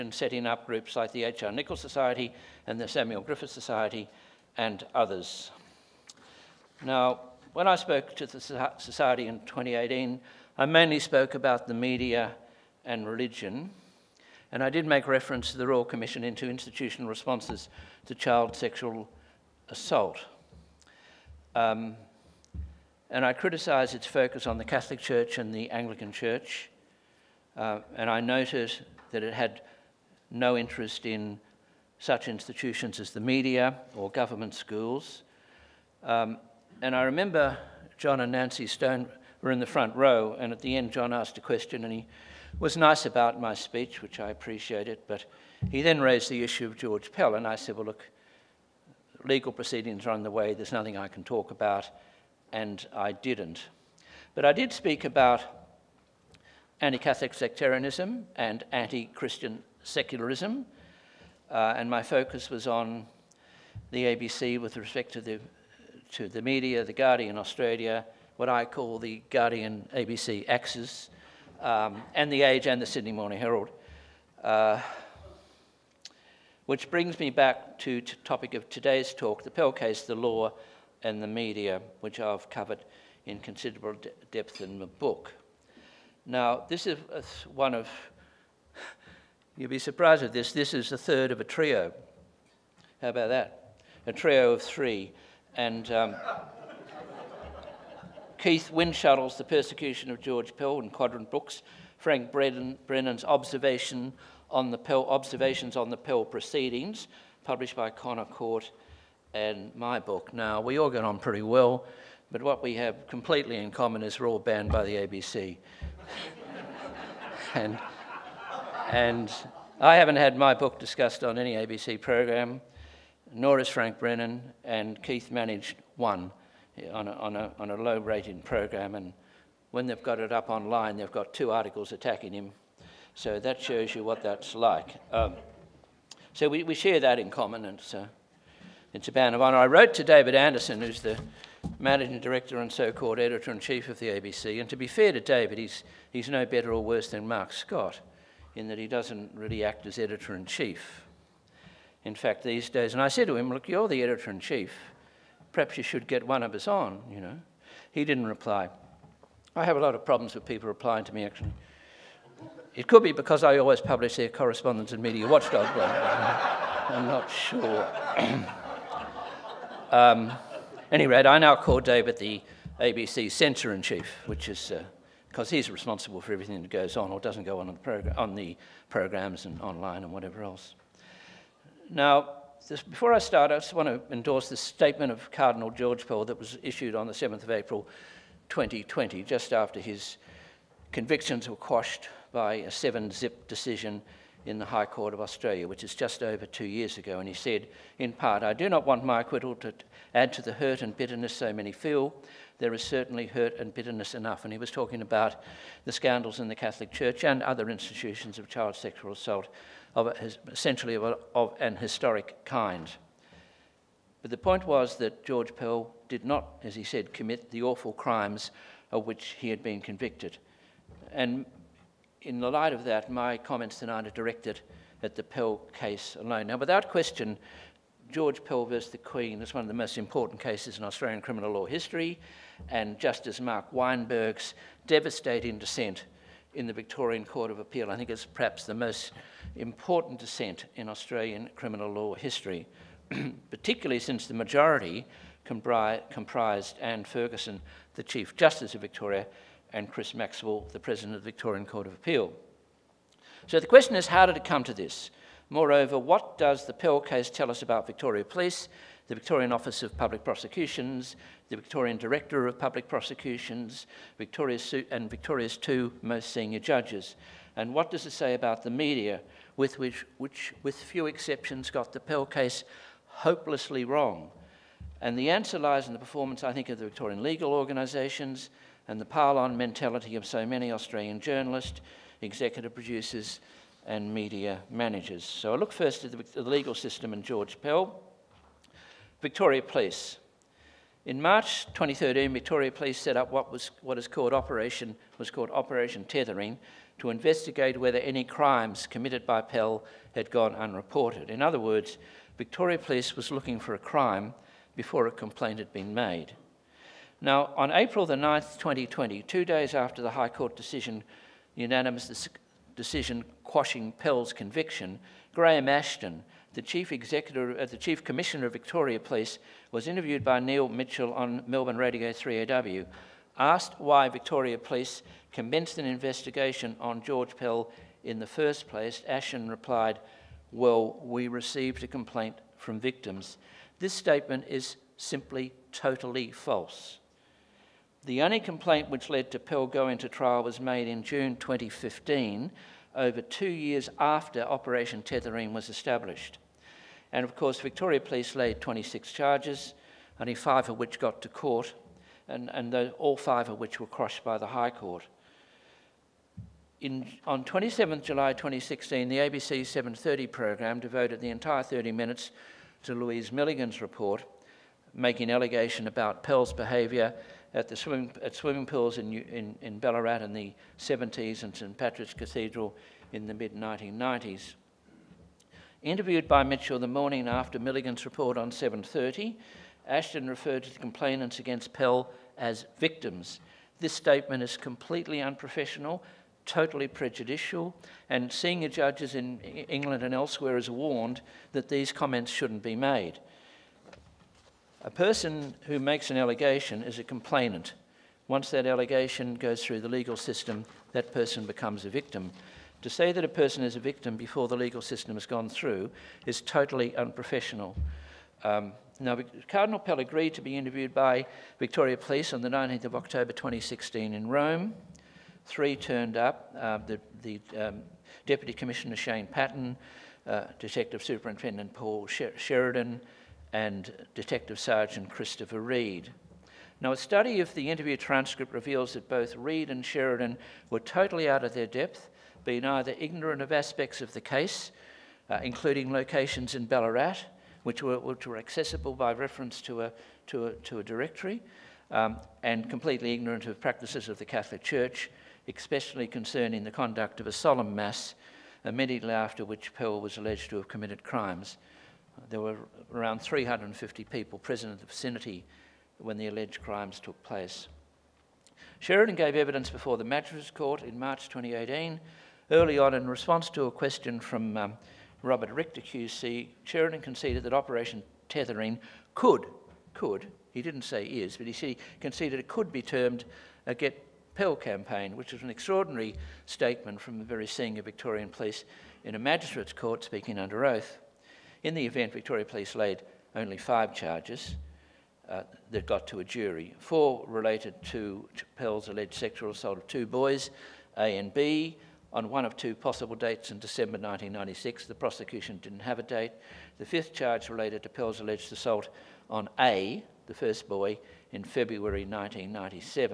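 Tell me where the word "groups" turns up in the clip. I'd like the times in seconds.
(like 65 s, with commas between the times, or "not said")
0 s.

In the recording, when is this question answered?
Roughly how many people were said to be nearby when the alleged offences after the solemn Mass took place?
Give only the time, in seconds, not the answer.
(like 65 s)
453 s.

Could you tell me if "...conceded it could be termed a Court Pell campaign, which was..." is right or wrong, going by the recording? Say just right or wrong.
wrong.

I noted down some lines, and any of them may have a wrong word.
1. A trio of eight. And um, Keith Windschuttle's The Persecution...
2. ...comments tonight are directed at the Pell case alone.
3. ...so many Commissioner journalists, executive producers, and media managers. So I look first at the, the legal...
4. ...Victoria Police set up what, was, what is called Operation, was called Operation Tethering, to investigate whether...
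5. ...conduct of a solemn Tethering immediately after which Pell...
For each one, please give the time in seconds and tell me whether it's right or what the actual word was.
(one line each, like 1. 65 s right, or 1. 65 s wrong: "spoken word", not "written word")
1. 94 s wrong: "three", not "eight"
2. 223 s right
3. 280 s wrong: "Australian", not "Commissioner"
4. 292 s right
5. 446 s wrong: "Mass", not "Tethering".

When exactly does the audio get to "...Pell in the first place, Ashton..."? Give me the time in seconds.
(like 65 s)
327 s.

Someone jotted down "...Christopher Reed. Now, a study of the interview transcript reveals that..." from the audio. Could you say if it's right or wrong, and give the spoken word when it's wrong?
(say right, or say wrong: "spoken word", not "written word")
right.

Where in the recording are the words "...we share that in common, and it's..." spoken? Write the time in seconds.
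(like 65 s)
136 s.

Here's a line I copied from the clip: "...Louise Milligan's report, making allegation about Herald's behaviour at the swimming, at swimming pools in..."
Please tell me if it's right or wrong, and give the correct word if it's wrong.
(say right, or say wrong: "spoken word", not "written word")
wrong: "Pell", not "Herald".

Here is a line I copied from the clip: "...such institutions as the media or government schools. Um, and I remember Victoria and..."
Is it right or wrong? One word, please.
wrong.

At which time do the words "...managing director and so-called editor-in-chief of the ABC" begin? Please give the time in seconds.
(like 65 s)
141 s.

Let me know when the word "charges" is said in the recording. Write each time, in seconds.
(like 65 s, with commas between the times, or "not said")
349 s, 483 s, 497 s.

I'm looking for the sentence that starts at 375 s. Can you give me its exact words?
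Interviewed by Mitchell the morning after Milligan's report on 7.30, Ashton referred to the complainants against Pell as victims.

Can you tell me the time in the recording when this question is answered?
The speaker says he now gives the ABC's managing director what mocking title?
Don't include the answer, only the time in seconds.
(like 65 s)
172 s.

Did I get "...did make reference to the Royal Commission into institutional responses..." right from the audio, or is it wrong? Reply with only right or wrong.
right.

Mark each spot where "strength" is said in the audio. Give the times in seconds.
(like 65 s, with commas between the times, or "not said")
not said.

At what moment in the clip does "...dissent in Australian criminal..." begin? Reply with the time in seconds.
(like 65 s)
240 s.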